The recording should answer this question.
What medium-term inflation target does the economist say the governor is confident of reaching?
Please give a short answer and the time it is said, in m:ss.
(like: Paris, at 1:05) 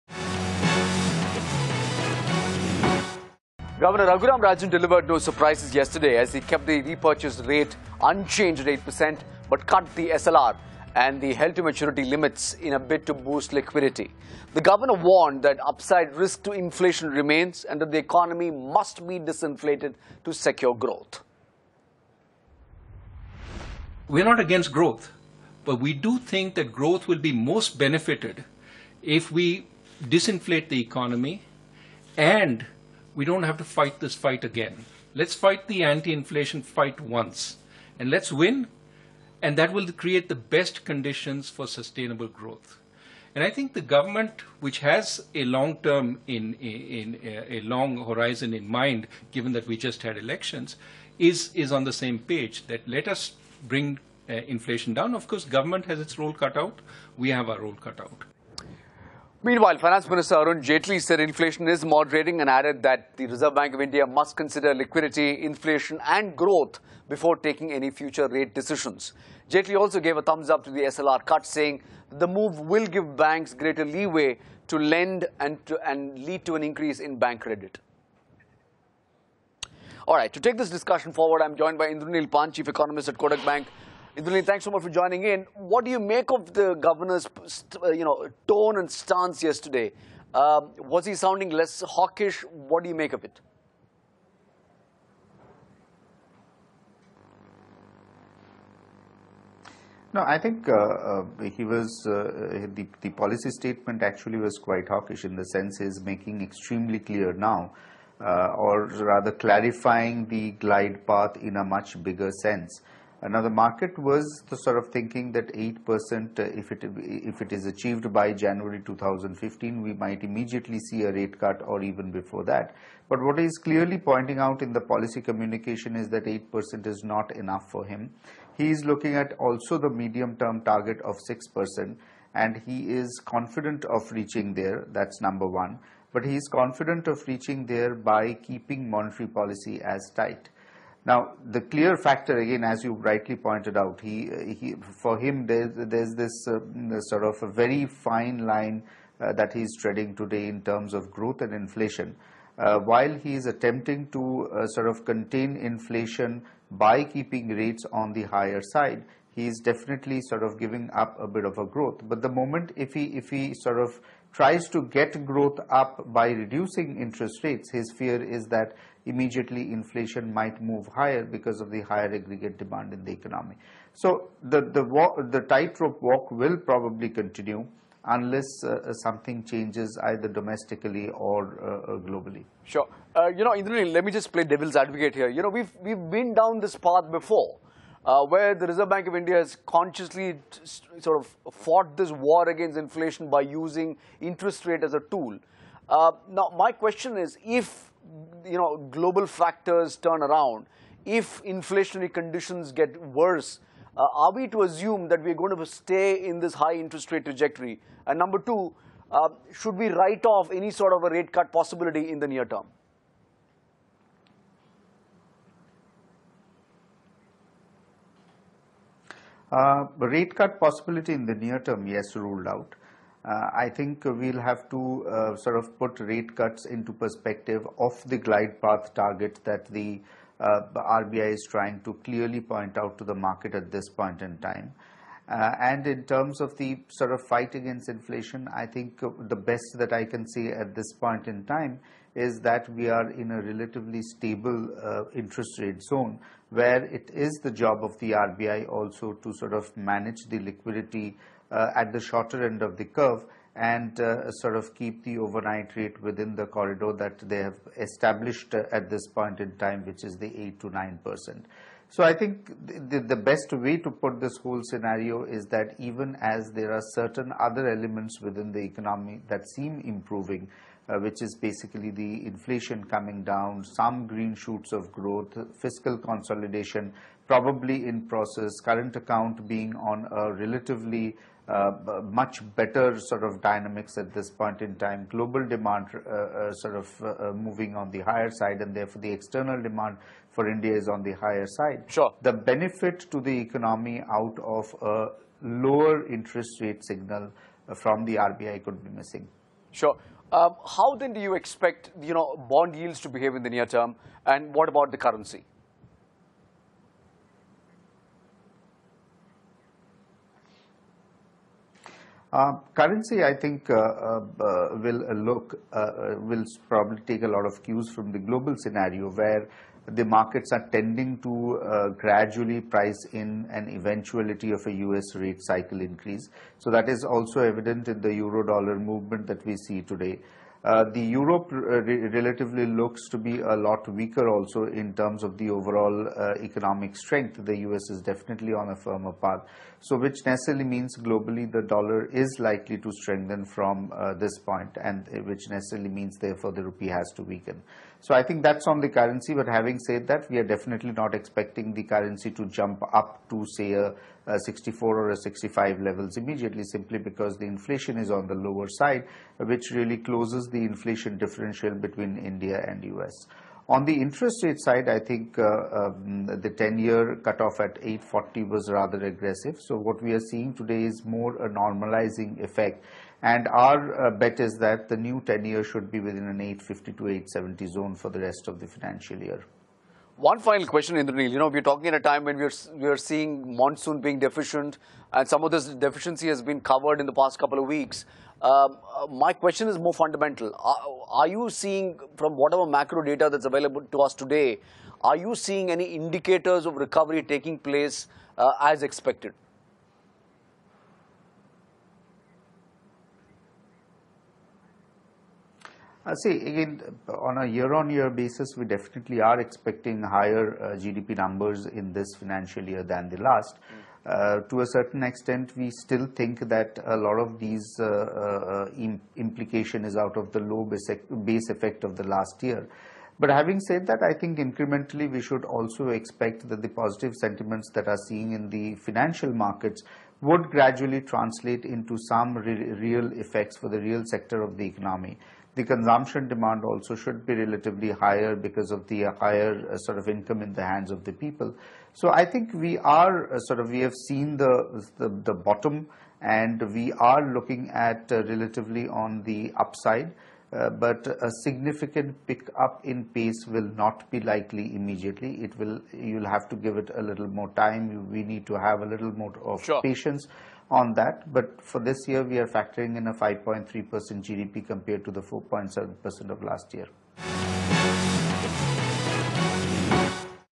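6%, at 2:11.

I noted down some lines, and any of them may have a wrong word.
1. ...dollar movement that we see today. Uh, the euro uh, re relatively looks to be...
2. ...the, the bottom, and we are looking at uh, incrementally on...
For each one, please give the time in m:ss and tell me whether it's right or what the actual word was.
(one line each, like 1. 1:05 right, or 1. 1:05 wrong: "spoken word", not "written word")
1. 5:28 right
2. 7:24 wrong: "relatively", not "incrementally".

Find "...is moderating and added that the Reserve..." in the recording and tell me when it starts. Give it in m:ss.
1:01.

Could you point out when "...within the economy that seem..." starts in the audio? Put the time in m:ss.
4:28.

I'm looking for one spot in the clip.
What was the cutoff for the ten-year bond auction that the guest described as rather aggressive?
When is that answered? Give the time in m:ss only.
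6:07.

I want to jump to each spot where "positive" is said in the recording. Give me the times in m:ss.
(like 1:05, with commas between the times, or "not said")
7:06.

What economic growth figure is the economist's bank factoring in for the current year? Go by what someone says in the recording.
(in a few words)
5.3%.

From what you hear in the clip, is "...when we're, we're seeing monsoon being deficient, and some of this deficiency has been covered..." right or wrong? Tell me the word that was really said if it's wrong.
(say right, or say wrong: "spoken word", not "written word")
right.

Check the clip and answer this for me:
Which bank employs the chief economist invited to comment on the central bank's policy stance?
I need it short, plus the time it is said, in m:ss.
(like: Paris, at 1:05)
Kotak Bank, at 1:23.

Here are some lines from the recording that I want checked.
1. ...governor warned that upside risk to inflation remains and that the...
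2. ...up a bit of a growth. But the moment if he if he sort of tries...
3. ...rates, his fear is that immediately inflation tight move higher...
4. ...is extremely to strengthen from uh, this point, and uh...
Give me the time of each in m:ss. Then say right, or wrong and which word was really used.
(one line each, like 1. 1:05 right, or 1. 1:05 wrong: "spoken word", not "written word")
1. 0:14 right
2. 2:40 right
3. 2:47 wrong: "might", not "tight"
4. 5:42 wrong: "likely", not "extremely".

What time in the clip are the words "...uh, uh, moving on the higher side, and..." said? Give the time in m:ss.
4:47.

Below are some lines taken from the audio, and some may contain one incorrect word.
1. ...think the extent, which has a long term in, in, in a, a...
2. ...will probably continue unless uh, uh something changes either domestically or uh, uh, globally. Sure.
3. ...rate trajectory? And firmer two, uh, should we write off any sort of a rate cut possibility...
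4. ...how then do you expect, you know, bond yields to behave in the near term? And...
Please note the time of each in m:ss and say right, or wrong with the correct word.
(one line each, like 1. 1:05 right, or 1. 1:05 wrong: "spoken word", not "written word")
1. 0:43 wrong: "government", not "extent"
2. 2:56 right
3. 3:27 wrong: "number", not "firmer"
4. 5:00 right.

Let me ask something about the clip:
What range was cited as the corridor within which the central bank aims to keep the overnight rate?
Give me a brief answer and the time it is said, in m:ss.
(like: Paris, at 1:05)
8 to 9 percent, at 4:20.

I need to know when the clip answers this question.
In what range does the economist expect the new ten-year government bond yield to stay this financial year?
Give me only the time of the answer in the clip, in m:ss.
6:16.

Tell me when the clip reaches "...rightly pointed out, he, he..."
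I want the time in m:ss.
2:22.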